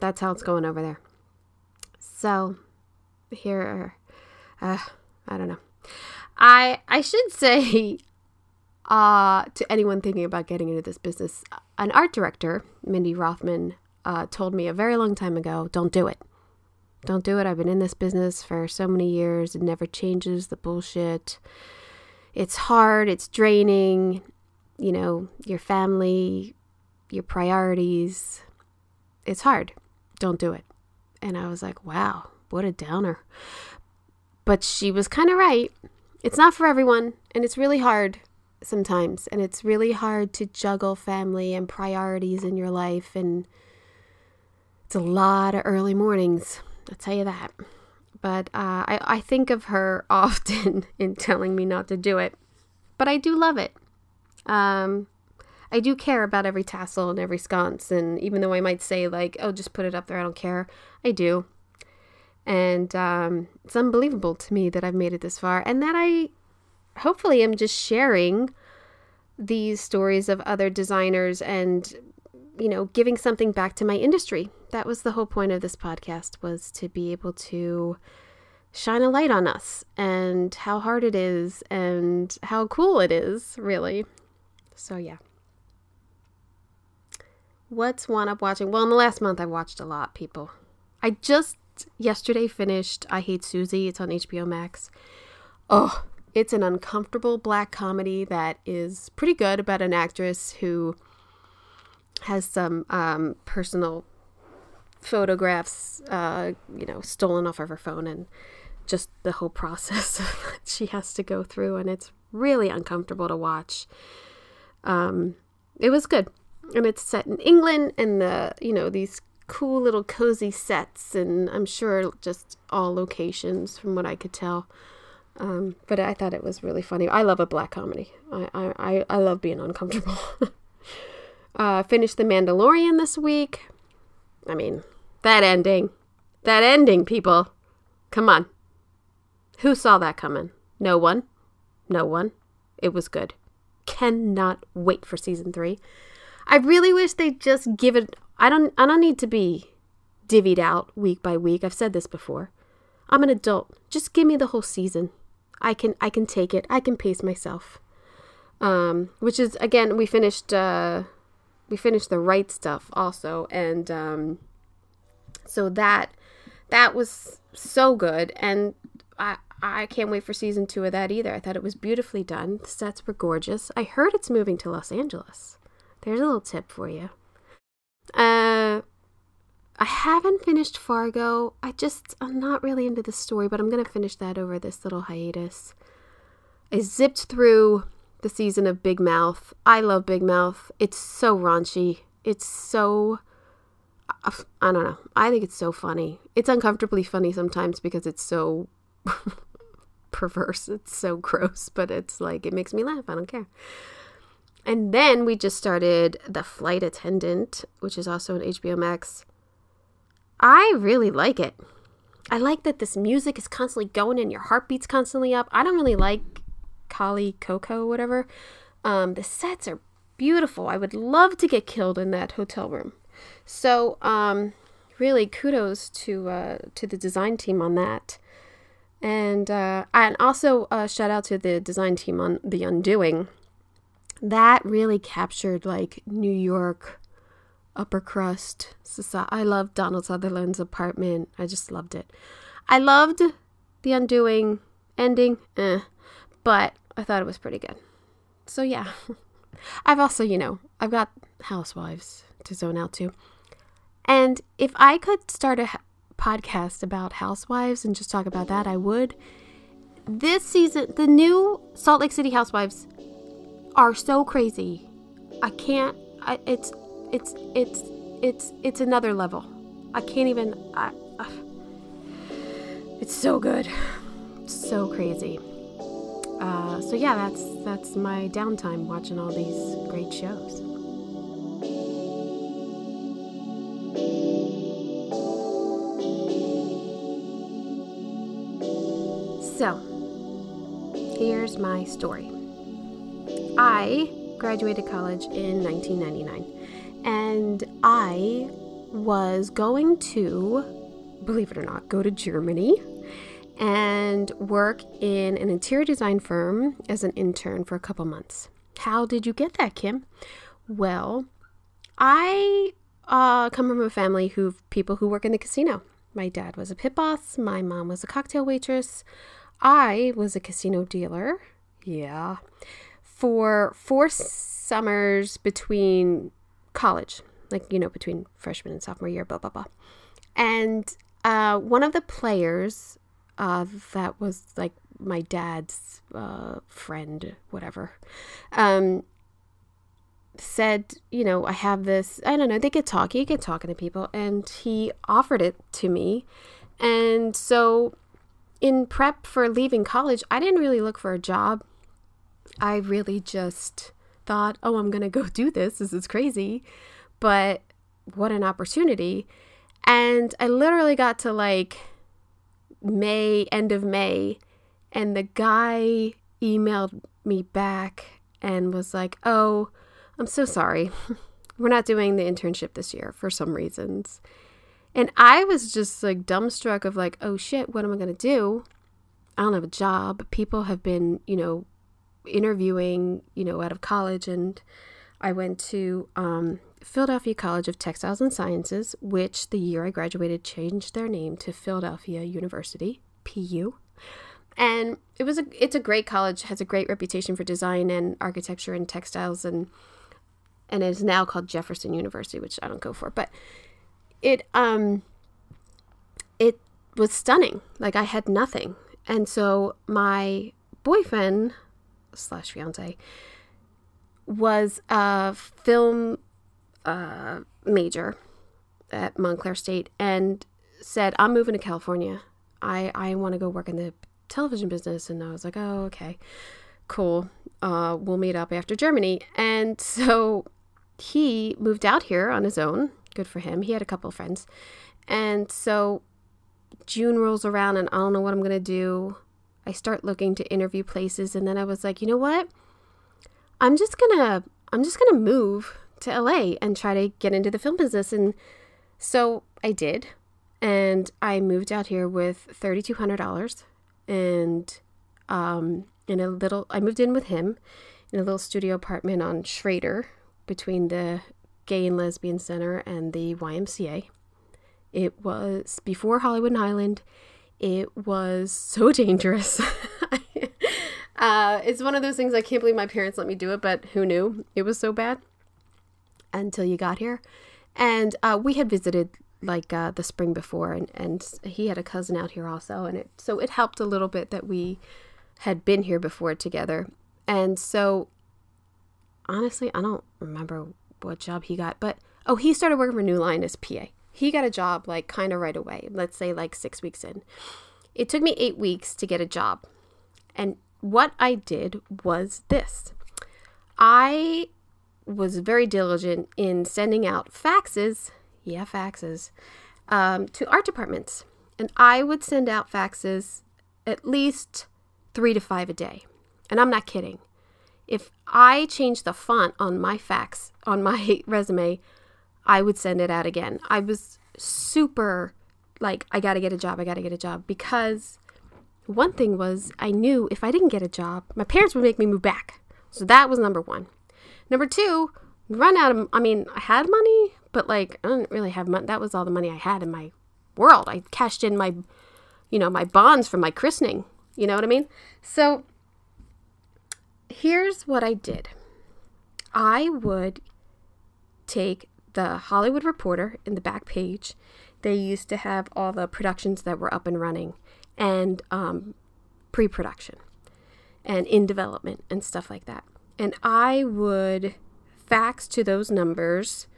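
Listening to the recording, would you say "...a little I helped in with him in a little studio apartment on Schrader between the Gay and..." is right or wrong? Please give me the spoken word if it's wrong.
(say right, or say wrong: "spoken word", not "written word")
wrong: "moved", not "helped".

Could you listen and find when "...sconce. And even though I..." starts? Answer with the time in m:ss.
0:57.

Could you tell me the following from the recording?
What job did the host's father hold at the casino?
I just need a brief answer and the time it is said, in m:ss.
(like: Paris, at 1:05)
Pit boss, at 5:16.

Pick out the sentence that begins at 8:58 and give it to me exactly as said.
That was all the money I had in my world.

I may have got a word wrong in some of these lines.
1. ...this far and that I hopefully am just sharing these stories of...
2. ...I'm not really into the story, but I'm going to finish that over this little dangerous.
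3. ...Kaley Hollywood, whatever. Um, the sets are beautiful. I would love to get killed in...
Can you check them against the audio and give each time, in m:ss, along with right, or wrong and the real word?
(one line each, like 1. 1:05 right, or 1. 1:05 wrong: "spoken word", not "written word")
1. 1:05 right
2. 3:02 wrong: "hiatus", not "dangerous"
3. 3:36 wrong: "Cuoco", not "Hollywood".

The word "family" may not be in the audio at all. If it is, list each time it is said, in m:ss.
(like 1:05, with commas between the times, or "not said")
0:25, 0:40, 5:13.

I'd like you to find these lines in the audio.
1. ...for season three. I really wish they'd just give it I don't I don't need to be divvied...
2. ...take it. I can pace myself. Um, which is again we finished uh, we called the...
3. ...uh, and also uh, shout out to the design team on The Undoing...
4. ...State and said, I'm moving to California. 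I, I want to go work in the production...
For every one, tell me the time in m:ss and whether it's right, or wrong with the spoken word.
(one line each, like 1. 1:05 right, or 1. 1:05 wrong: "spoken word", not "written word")
1. 2:25 right
2. 2:36 wrong: "finished", not "called"
3. 3:49 right
4. 6:59 wrong: "television", not "production".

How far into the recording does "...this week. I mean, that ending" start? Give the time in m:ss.
2:12.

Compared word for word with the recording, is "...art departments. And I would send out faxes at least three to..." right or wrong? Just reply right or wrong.
right.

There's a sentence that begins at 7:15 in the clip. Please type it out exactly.
And so June rolls around and I don't know what I'm going to do.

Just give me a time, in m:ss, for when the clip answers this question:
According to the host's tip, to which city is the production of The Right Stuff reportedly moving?
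2:54.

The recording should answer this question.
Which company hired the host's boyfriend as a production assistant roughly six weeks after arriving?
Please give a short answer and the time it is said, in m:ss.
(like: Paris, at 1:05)
New Line, at 8:13.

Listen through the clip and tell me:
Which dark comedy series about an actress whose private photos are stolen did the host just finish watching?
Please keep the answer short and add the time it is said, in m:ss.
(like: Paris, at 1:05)
I Hate Suzie, at 1:33.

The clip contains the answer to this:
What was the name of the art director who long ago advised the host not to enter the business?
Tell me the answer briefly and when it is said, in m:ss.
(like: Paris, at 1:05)
Mindy Rothman, at 0:12.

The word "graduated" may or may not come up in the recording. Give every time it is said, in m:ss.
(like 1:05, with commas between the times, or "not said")
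4:54, 6:29.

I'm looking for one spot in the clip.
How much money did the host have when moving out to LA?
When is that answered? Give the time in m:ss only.
7:32.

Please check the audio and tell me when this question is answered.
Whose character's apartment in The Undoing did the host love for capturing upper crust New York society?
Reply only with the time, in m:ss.
3:59.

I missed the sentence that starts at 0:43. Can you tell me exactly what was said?
And it's a lot of early mornings, I'll tell you that.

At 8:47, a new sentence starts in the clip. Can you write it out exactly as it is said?
Because one thing was, I knew if I didn't get a job, my parents would make me move back.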